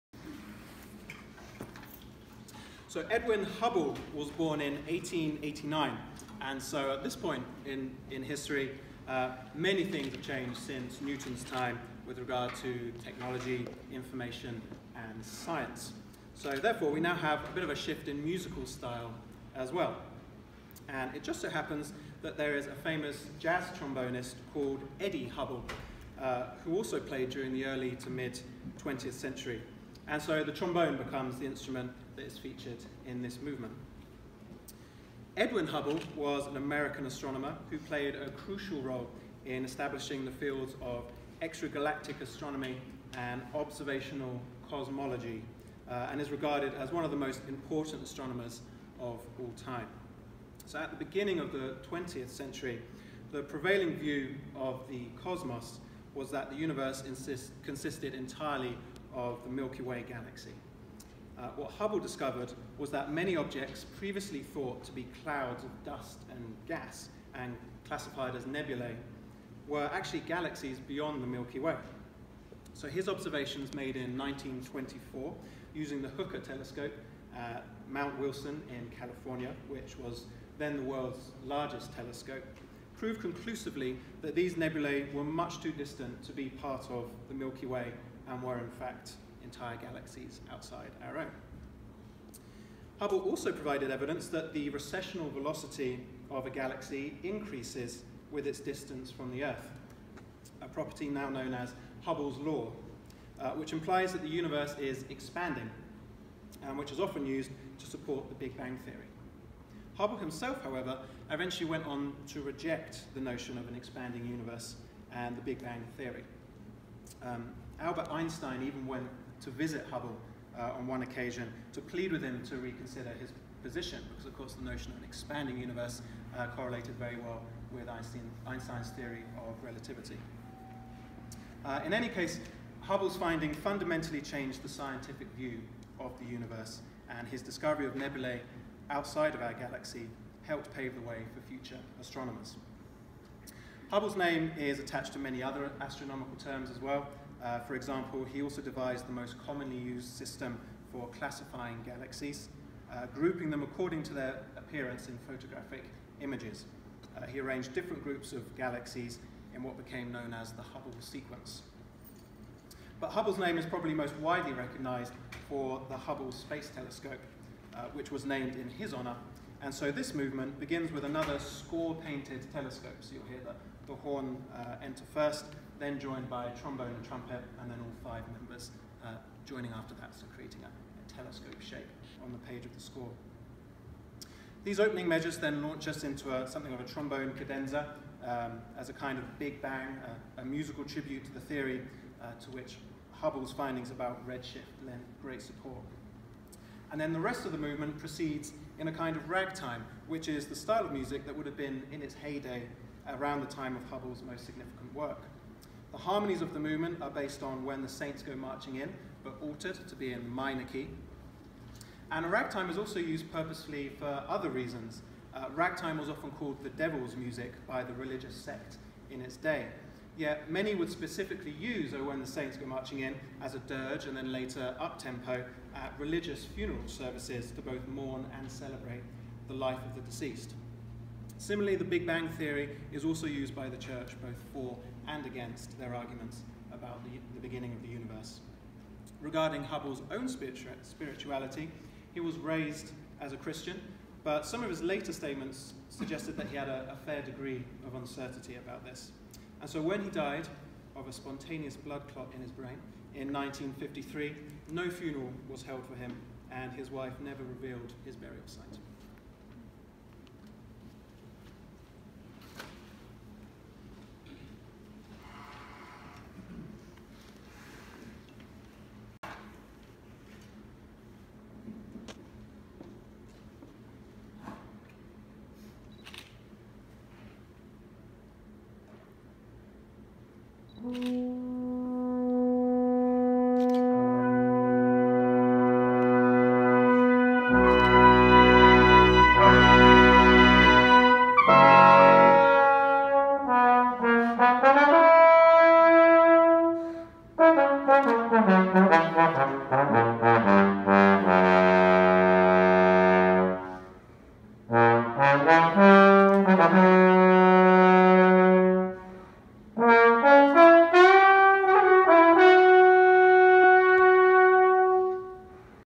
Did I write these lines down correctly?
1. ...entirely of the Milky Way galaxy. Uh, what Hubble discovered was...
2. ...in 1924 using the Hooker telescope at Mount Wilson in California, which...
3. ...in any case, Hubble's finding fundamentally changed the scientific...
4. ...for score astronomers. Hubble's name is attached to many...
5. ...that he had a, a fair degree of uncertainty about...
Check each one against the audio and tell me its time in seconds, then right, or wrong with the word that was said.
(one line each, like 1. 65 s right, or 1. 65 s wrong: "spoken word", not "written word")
1. 58 s right
2. 73 s right
3. 131 s right
4. 141 s wrong: "future", not "score"
5. 246 s right.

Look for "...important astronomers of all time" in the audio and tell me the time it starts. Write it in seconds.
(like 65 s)
47 s.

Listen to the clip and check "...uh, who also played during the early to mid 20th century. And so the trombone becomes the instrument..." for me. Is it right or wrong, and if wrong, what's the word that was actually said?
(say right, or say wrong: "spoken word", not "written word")
right.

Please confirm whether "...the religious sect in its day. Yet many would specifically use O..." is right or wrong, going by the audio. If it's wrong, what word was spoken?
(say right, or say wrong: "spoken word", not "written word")
right.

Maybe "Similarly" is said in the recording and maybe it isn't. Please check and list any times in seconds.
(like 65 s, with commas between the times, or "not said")
231 s.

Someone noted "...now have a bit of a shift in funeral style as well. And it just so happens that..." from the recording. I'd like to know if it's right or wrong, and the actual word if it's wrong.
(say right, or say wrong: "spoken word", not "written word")
wrong: "musical", not "funeral".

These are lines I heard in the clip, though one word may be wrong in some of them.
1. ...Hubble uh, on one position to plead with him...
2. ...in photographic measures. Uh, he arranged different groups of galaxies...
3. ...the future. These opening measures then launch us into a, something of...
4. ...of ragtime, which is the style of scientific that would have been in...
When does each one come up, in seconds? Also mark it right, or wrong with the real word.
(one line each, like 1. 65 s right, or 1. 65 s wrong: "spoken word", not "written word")
1. 119 s wrong: "occasion", not "position"
2. 155 s wrong: "images", not "measures"
3. 182 s wrong: "score", not "future"
4. 199 s wrong: "music", not "scientific".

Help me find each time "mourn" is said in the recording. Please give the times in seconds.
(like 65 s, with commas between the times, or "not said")
227 s.